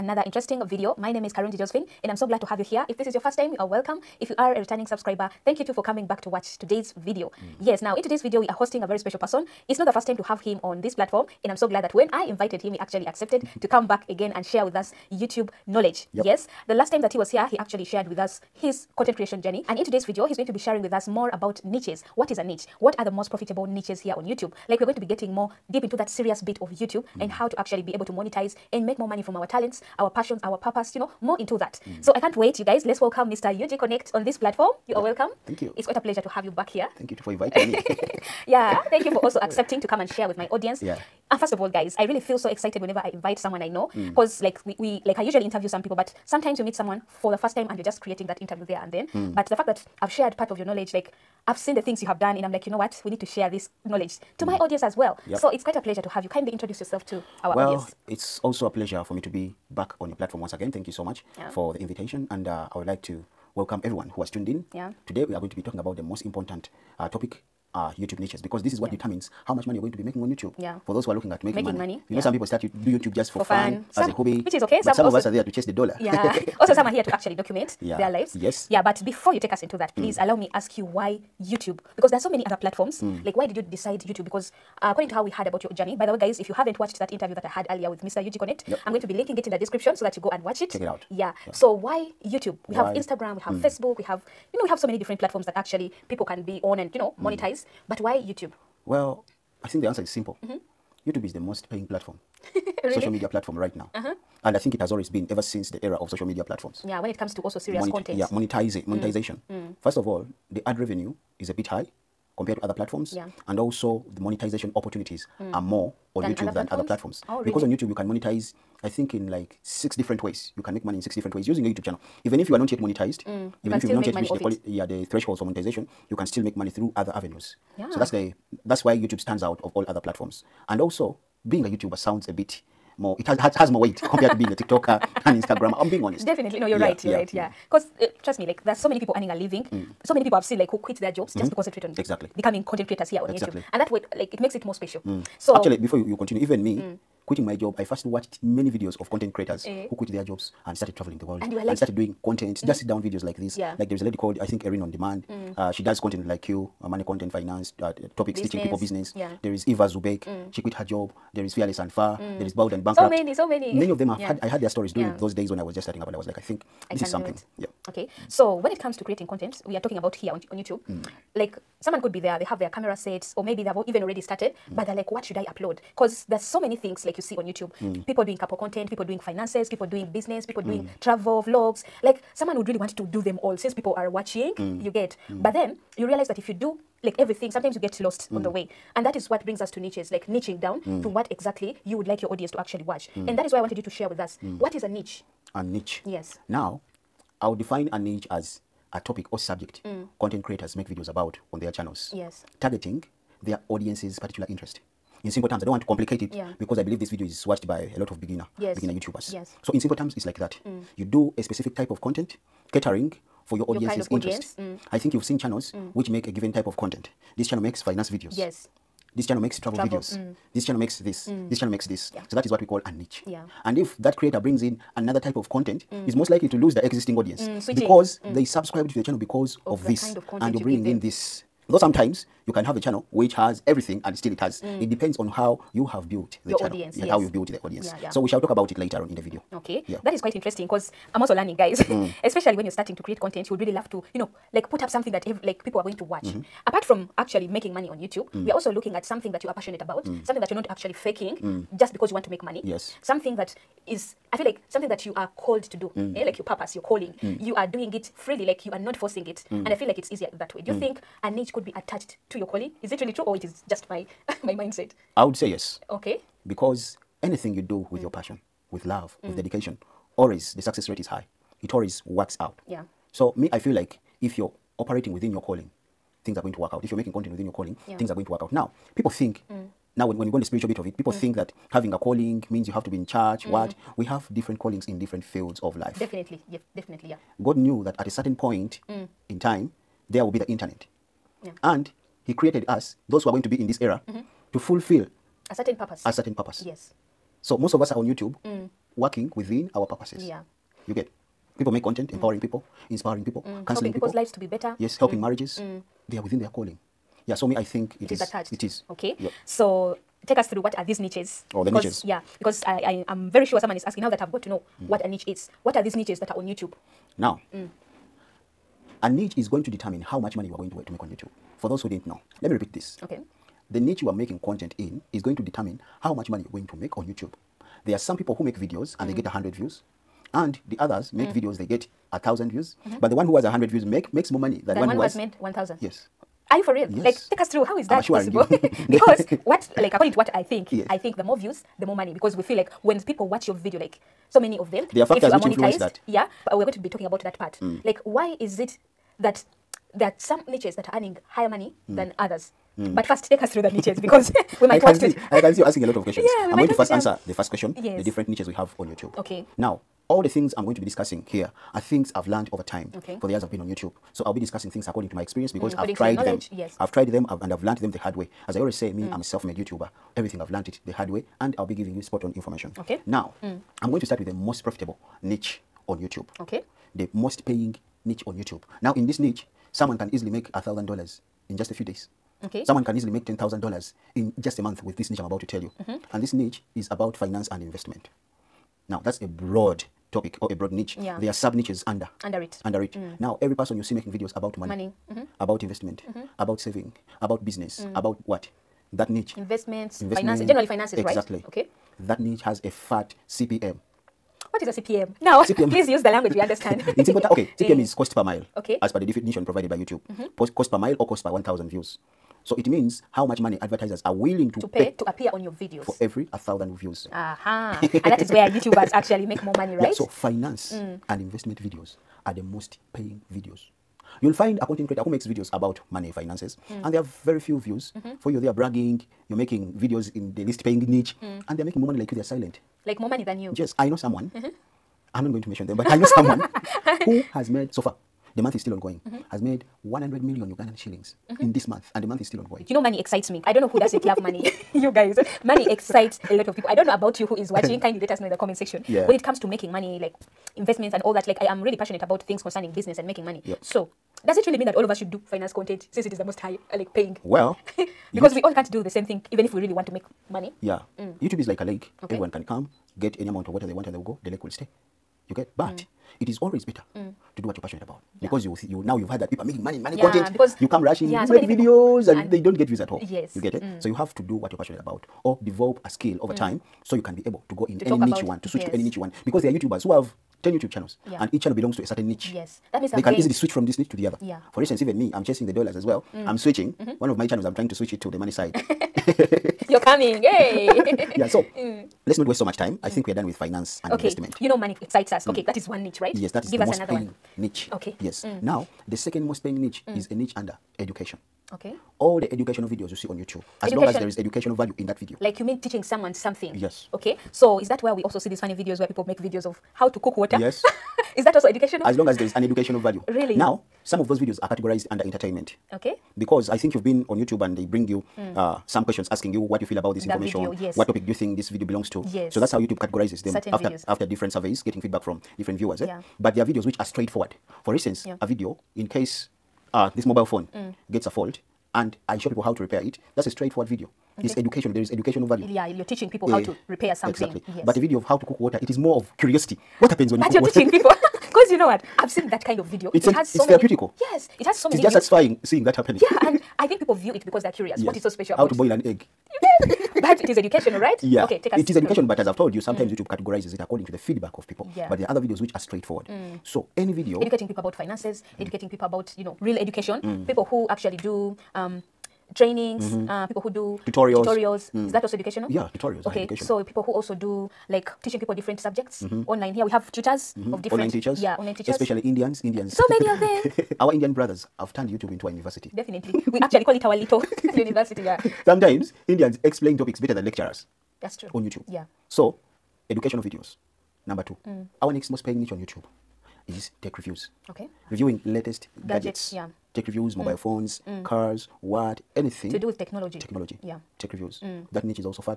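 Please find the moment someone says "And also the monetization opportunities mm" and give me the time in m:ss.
1:53.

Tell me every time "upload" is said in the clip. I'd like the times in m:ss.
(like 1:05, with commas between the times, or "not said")
2:55.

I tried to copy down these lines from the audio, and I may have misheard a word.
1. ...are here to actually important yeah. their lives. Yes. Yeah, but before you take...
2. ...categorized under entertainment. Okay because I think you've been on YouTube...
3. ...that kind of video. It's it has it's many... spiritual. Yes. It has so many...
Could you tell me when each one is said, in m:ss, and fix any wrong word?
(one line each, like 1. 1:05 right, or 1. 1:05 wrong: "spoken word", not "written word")
1. 1:16 wrong: "document", not "important"
2. 8:34 right
3. 9:02 wrong: "therapeutical", not "spiritual".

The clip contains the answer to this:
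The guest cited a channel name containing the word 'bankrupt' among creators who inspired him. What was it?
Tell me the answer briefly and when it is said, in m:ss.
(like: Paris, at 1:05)
Bold and Bankrupt, at 2:42.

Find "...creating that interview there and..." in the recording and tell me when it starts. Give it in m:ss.
0:48.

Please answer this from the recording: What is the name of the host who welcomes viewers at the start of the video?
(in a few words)
Karungi Josephine.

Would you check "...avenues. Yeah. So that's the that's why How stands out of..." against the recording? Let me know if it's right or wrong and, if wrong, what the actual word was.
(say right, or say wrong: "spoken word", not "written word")
wrong: "YouTube", not "How".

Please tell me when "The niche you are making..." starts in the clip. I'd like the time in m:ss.
5:23.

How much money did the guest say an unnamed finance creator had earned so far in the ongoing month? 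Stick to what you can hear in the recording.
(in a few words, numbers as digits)
100 million Ugandan shillings.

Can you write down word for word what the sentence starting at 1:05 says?
Today we are going to be talking about the most important uh, topic uh, YouTube niches because this is what yeah.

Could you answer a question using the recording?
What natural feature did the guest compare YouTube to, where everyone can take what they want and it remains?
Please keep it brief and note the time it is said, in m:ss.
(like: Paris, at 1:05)
a lake, at 7:41.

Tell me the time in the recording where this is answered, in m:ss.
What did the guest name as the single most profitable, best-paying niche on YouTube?
6:27.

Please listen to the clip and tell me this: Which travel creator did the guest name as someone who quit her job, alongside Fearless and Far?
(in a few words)
Eva zu Beck.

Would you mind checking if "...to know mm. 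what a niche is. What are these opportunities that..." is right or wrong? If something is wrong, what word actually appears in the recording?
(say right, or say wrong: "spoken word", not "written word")
wrong: "niches", not "opportunities".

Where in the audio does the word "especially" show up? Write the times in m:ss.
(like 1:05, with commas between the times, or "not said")
4:02, 9:31.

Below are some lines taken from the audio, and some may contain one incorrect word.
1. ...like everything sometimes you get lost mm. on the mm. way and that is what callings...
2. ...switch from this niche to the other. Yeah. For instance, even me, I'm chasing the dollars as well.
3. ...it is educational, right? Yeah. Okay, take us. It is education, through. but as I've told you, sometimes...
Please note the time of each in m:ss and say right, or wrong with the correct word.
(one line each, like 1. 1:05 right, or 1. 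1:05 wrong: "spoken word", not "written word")
1. 3:07 wrong: "brings", not "callings"
2. 8:03 right
3. 9:10 right.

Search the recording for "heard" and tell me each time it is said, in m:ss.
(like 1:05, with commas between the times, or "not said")
1:25, 7:49.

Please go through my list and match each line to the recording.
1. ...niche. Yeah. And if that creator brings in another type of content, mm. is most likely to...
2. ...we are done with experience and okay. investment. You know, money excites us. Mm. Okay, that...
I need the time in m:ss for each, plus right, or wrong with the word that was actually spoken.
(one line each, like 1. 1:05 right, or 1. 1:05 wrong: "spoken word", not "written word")
1. 3:42 right
2. 8:13 wrong: "finance", not "experience".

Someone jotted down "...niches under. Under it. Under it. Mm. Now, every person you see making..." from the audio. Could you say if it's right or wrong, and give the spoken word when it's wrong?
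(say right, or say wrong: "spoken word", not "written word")
right.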